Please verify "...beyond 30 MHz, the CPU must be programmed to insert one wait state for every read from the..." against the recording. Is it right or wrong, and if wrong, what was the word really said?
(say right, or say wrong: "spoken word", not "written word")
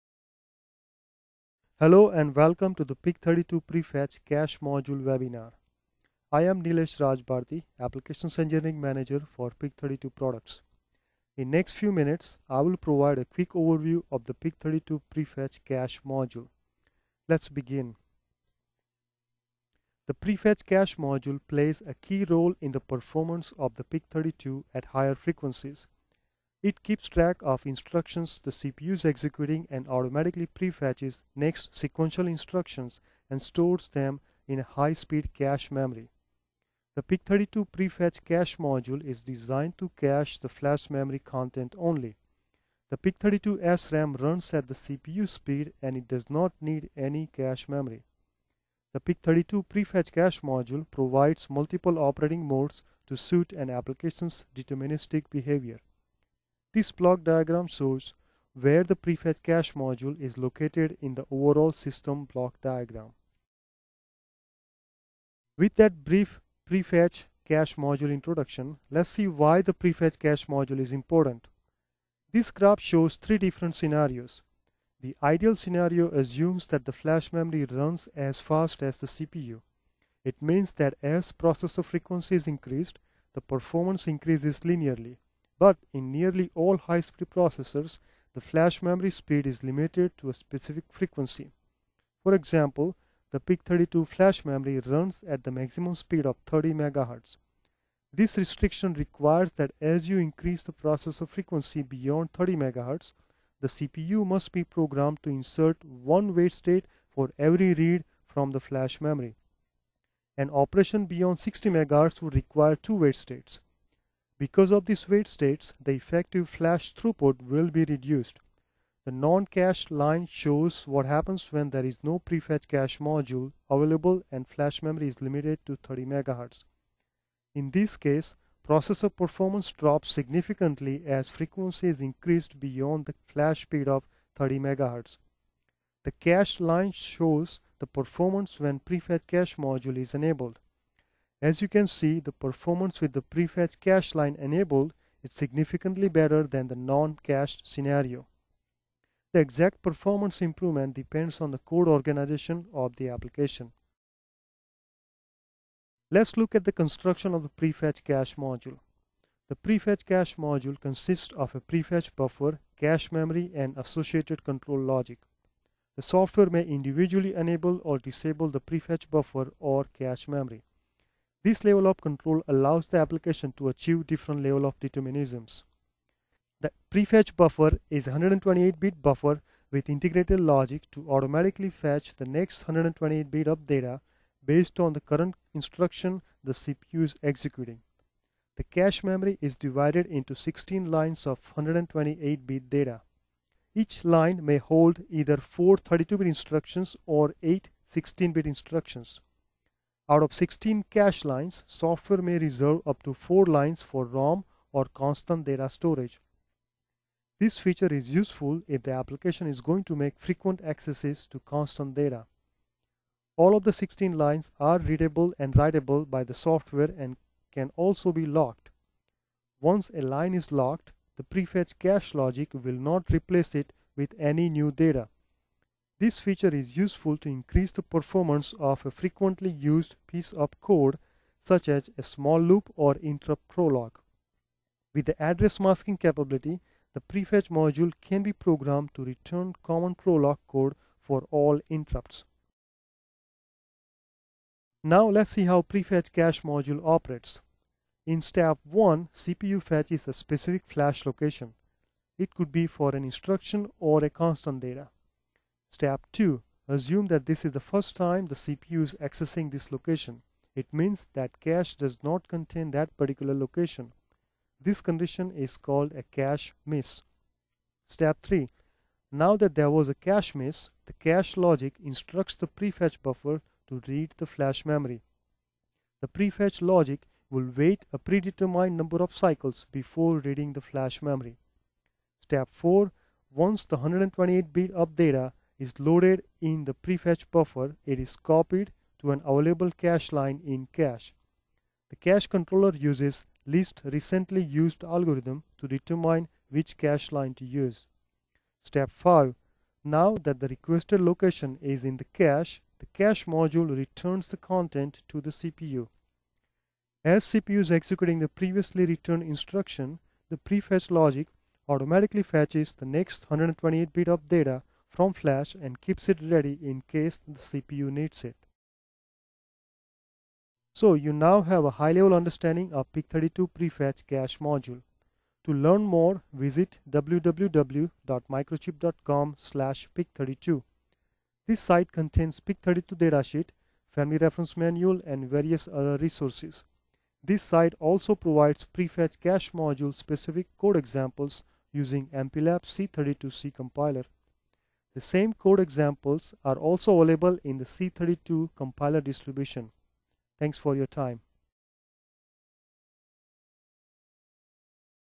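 right.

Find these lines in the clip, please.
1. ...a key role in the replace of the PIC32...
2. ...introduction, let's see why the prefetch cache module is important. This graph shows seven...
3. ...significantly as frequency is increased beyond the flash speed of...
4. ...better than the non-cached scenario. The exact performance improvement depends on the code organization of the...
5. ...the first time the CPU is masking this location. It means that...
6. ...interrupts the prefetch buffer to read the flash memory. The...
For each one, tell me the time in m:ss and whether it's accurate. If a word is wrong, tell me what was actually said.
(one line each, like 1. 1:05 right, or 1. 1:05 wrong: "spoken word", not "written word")
1. 0:21 wrong: "performance", not "replace"
2. 1:08 wrong: "three", not "seven"
3. 2:10 right
4. 2:26 right
5. 4:17 wrong: "accessing", not "masking"
6. 4:31 wrong: "instructs", not "interrupts".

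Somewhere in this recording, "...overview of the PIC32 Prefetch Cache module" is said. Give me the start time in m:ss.
0:13.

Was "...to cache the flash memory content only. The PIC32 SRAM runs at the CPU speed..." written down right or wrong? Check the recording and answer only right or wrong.
right.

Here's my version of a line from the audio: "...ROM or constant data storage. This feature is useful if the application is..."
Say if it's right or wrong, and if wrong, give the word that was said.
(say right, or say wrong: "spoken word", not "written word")
right.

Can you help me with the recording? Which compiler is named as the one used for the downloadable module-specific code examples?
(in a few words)
MPLAB C32.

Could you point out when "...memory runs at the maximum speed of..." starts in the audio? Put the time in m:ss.
1:34.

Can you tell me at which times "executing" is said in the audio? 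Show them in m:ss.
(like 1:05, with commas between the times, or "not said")
0:29, 3:07, 5:07.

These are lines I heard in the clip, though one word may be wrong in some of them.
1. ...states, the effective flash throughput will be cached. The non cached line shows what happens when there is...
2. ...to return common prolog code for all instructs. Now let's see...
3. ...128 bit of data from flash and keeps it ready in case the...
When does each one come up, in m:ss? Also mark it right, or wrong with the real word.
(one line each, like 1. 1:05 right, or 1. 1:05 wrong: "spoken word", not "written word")
1. 1:55 wrong: "reduced", not "cached"
2. 3:58 wrong: "interrupts", not "instructs"
3. 5:13 right.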